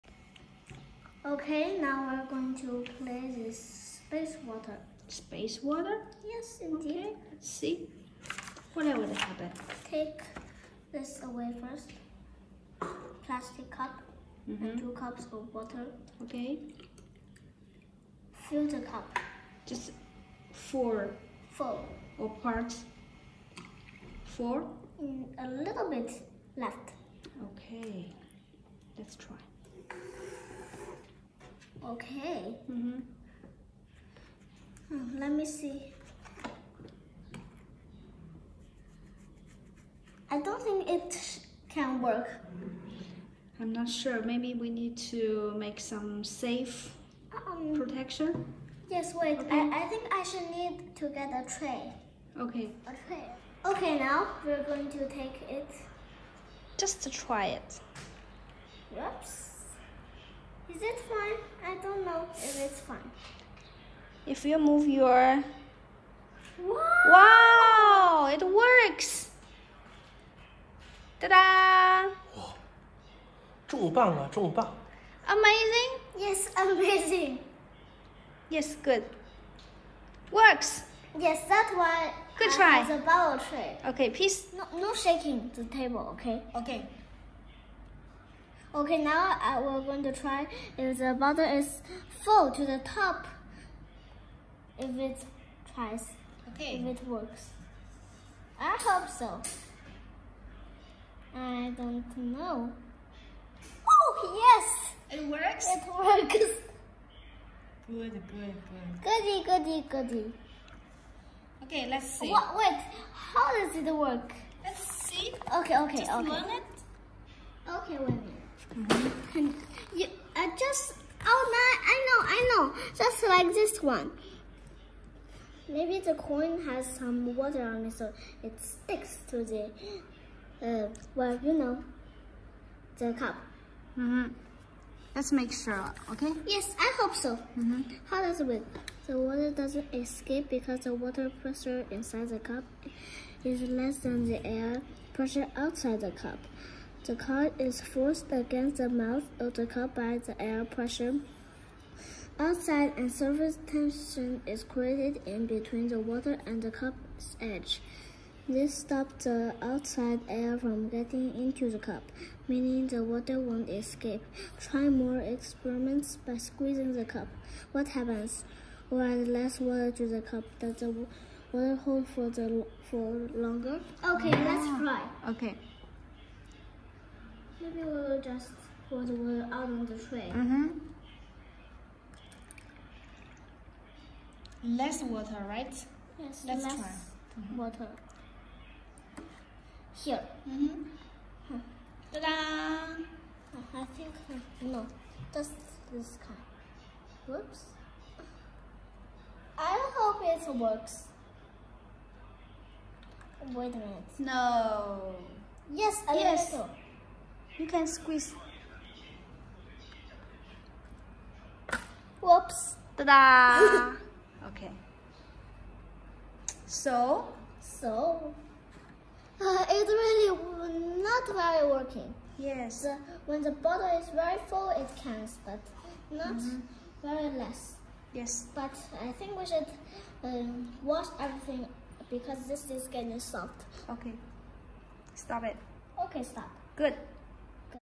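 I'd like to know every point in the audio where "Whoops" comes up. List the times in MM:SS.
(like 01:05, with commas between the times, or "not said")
00:58, 03:17, 03:32.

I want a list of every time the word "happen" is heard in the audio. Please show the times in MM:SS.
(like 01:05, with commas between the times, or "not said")
00:09, 02:47.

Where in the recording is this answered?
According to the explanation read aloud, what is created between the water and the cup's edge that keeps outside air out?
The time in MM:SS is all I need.
02:33.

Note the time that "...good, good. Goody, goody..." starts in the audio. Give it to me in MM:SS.
01:47.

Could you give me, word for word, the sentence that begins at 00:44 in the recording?
Maybe we need to make some safe um, protection.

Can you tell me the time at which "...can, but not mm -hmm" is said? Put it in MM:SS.
03:45.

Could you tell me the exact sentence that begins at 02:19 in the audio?
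The water doesn't escape because the water pressure inside the cup is less than the air pressure outside the cup.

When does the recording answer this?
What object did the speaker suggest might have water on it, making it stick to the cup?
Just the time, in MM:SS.
02:05.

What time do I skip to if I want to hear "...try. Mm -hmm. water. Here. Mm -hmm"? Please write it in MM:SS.
03:06.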